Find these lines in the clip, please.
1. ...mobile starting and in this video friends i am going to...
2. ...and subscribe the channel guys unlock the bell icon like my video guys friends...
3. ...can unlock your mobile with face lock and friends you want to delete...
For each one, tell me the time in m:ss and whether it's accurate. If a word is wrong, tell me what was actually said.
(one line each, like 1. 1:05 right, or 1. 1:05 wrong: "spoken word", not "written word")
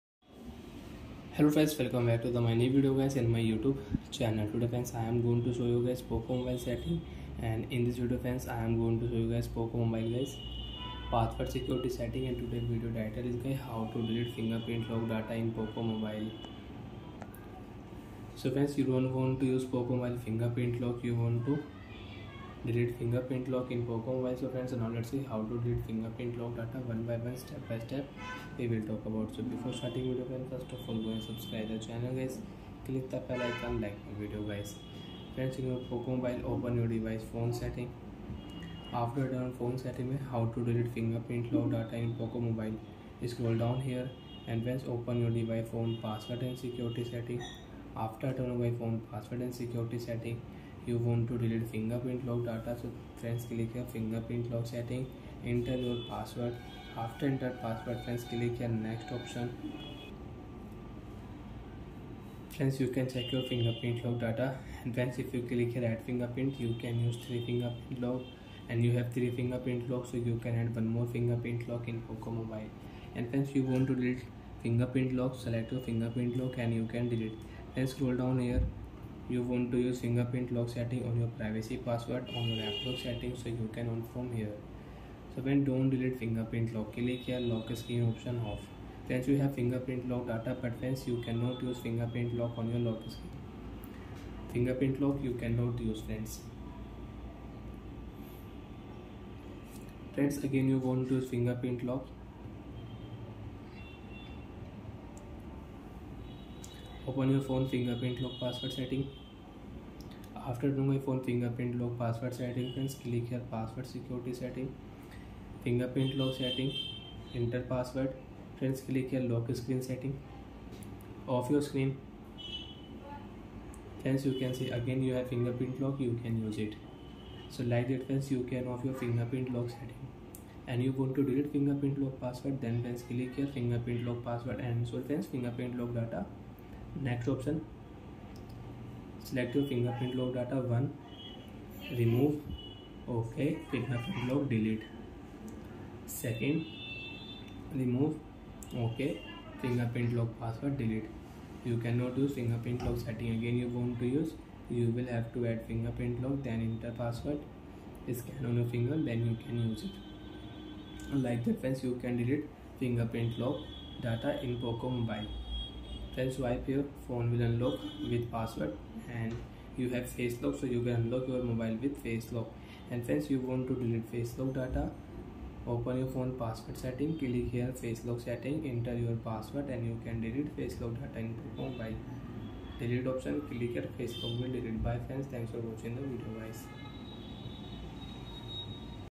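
1. 0:06 wrong: "setting", not "starting"
2. 0:31 wrong: "click", not "unlock"
3. 2:50 right.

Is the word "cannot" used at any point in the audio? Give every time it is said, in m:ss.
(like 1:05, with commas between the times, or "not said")
1:31, 1:35, 2:31.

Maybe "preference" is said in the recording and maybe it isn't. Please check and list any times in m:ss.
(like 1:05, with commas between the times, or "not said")
1:30.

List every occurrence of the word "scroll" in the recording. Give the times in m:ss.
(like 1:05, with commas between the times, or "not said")
0:43, 1:17.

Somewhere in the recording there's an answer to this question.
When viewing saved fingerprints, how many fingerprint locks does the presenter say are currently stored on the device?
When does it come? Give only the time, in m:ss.
1:08.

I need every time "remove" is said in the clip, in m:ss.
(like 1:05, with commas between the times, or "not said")
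2:21, 2:27.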